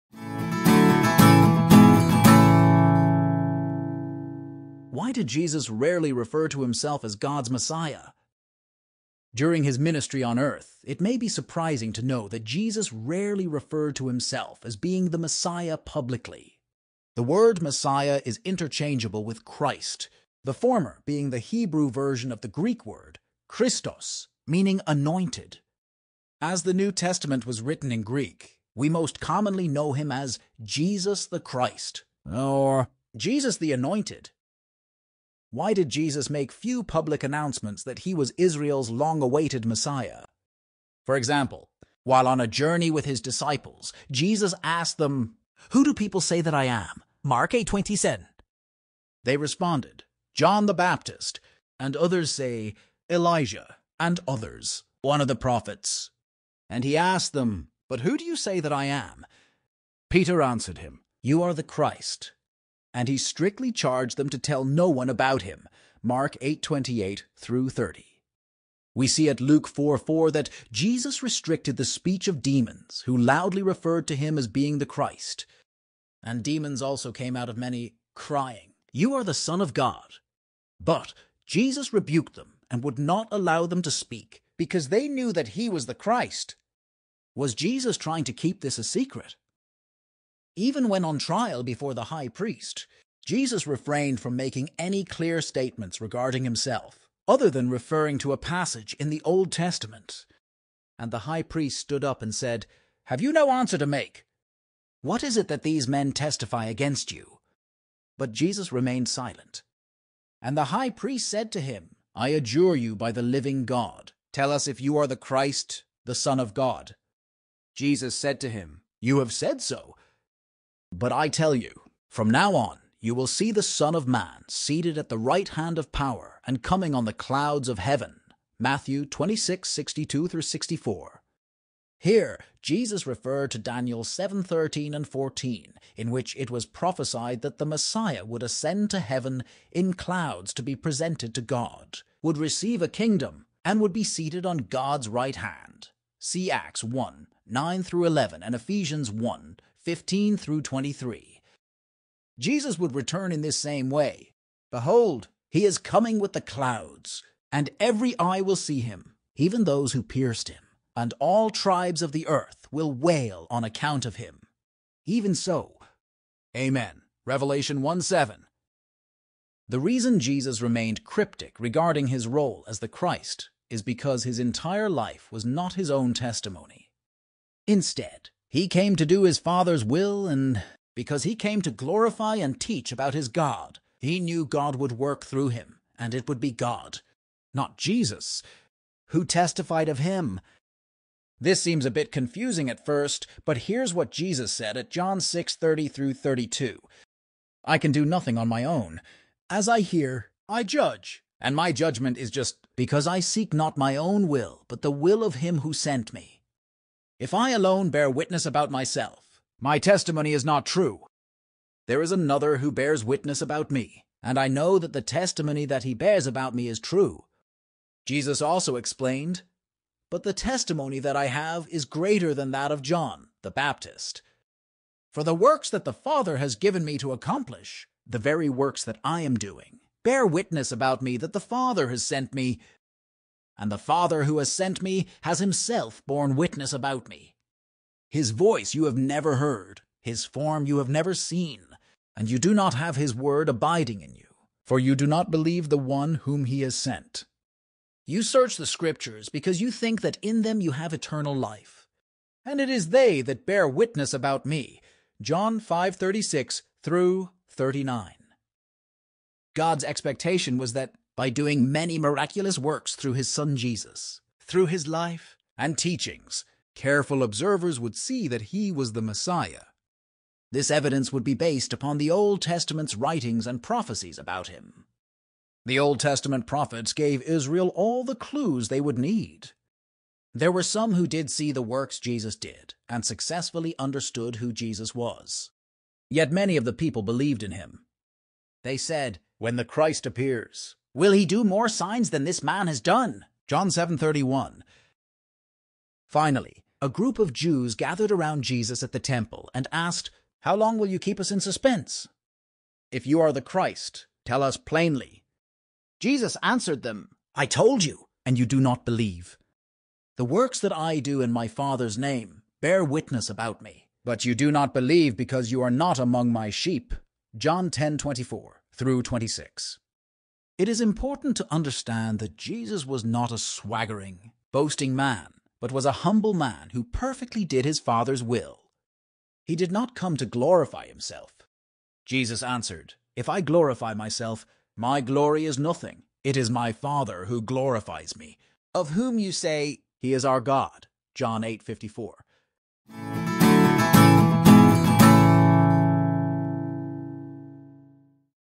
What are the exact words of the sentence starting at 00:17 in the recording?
The word Messiah is interchangeable with Christ, the former being the Hebrew version of the Greek word Christos, meaning anointed.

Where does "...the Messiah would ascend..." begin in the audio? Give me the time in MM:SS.
02:17.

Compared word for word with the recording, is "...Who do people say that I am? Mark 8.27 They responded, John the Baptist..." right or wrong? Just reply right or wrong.
right.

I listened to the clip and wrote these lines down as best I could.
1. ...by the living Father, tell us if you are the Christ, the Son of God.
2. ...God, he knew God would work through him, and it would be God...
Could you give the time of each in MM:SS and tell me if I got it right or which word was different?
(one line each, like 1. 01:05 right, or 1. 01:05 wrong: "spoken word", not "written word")
1. 01:52 wrong: "God", not "Father"
2. 03:03 right.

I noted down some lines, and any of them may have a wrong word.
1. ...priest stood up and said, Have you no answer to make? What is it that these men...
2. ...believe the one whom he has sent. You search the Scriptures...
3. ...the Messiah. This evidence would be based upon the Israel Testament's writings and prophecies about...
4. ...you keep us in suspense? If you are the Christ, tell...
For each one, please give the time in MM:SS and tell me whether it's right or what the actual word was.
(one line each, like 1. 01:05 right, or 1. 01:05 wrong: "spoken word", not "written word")
1. 01:41 right
2. 04:05 right
3. 04:28 wrong: "Old", not "Israel"
4. 05:00 right.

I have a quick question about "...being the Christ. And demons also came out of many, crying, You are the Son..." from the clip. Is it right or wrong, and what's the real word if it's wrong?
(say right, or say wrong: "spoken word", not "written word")
right.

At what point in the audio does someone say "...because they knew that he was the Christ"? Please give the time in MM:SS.
01:24.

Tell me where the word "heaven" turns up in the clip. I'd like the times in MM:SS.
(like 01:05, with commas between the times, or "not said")
02:07, 02:18.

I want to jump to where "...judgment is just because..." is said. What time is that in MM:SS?
03:21.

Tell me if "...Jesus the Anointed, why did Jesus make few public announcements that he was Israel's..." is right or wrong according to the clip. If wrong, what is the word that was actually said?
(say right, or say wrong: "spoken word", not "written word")
right.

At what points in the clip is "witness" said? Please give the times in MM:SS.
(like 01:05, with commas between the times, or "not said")
03:28, 03:33, 03:50, 03:56, 04:13, 05:12.